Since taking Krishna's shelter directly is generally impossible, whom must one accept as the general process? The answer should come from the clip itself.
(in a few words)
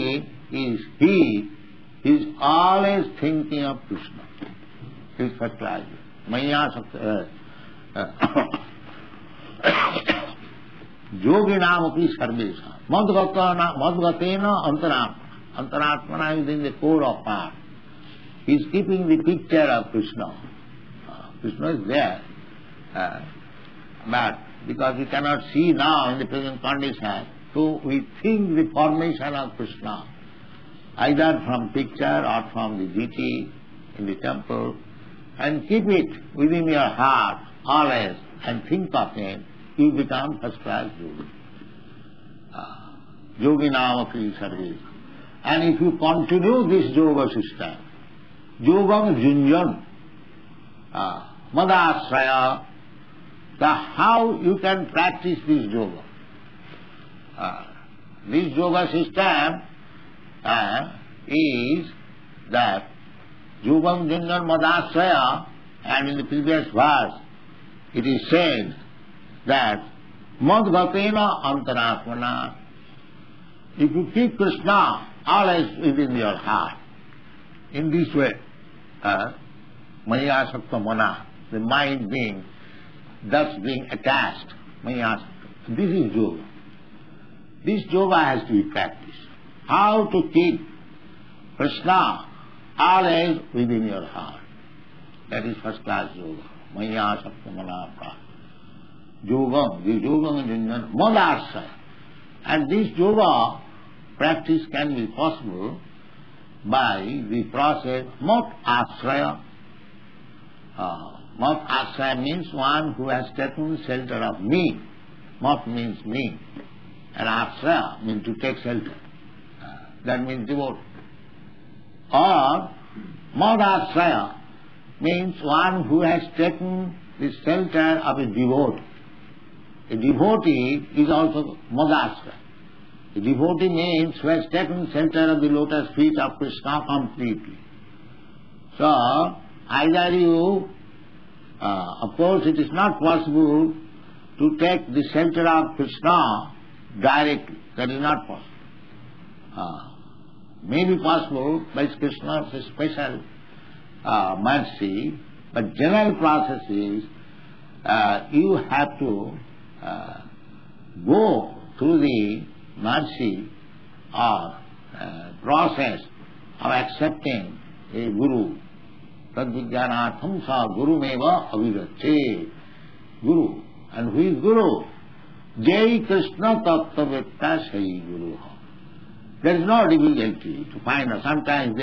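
A guru.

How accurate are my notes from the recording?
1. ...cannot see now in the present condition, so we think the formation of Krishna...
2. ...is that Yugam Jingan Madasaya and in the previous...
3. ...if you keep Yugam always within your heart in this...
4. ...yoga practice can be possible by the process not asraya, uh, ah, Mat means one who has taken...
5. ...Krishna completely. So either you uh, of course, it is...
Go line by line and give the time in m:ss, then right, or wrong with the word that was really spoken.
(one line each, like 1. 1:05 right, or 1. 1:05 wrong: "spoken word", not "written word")
1. 0:25 right
2. 1:01 right
3. 1:13 wrong: "Krishna", not "Yugam"
4. 1:42 right
5. 2:16 right.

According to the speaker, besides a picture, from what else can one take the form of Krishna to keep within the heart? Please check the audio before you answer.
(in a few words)
The deity in the temple.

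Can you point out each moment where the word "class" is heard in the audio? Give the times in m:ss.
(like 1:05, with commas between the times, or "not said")
0:05, 0:40, 1:35.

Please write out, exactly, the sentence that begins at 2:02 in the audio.
Or madasraya means one who has taken the shelter of a devotee.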